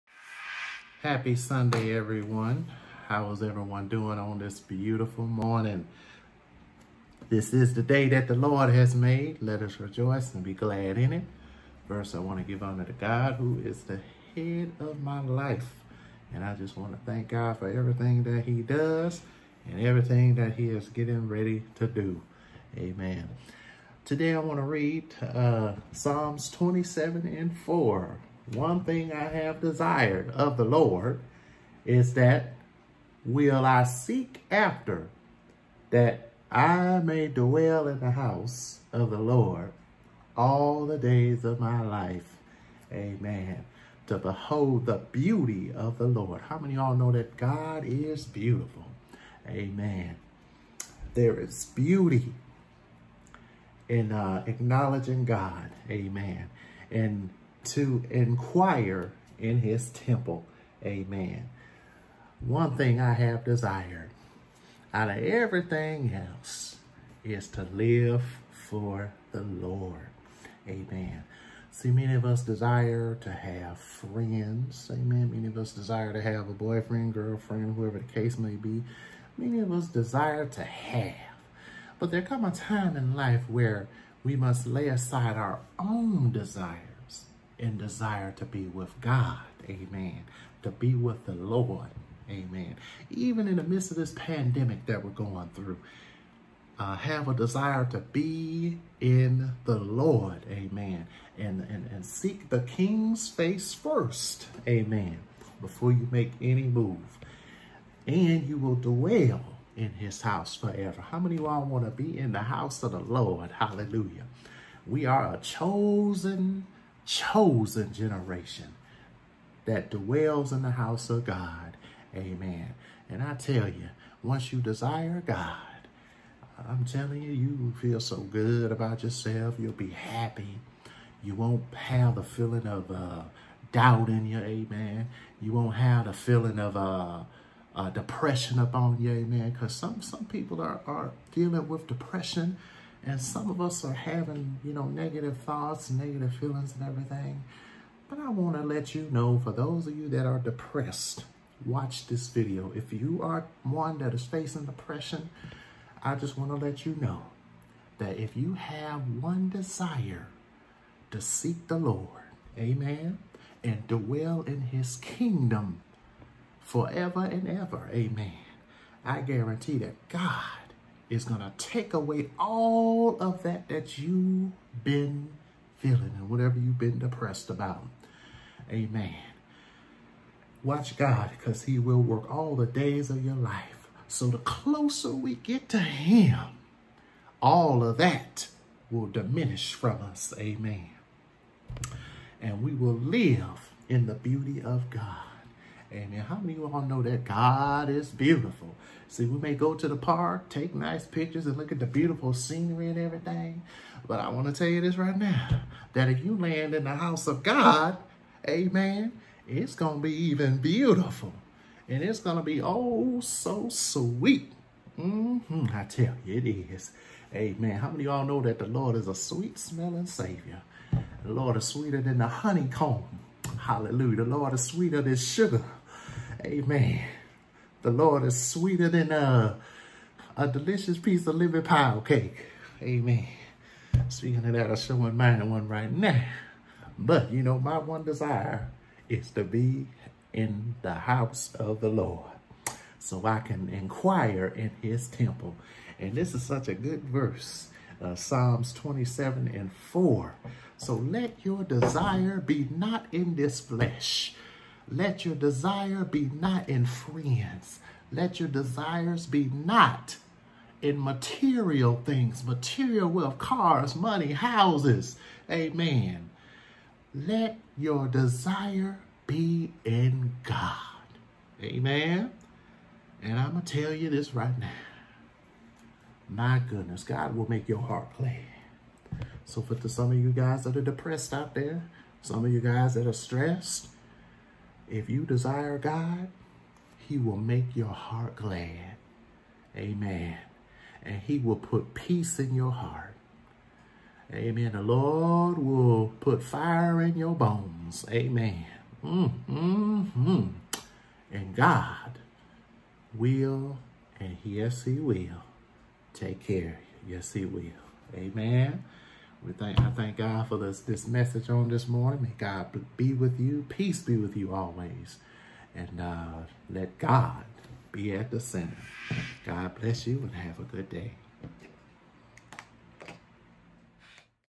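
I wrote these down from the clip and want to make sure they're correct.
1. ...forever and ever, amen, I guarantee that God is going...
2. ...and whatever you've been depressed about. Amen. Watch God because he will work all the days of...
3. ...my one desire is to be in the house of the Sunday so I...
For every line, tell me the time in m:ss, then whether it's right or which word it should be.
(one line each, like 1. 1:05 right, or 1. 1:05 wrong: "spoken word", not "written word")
1. 2:46 right
2. 2:56 right
3. 3:57 wrong: "Lord", not "Sunday".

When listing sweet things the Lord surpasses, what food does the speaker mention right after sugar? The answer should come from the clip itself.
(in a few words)
living pile cake.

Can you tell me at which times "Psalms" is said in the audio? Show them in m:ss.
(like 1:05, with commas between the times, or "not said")
0:25, 4:08.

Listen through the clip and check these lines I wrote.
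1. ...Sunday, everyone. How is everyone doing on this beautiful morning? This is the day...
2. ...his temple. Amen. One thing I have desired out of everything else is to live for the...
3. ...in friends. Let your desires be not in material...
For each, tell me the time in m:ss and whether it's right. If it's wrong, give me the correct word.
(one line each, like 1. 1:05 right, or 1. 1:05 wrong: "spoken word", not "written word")
1. 0:01 right
2. 0:59 right
3. 4:16 right.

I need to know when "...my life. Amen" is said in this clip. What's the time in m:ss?
0:41.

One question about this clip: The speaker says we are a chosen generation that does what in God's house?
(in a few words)
dwells.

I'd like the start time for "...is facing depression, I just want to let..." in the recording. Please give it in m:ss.
2:34.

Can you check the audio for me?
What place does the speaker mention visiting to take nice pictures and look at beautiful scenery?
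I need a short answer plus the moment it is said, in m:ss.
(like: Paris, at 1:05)
the park, at 3:19.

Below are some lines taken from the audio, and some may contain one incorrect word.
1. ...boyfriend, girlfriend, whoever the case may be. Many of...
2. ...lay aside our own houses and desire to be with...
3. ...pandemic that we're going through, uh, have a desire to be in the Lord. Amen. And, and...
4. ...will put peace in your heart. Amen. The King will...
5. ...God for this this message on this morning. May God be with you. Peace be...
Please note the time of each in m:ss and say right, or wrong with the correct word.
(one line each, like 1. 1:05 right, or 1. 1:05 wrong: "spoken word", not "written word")
1. 1:16 right
2. 1:24 wrong: "desires", not "houses"
3. 1:34 right
4. 4:51 wrong: "Lord", not "King"
5. 5:10 right.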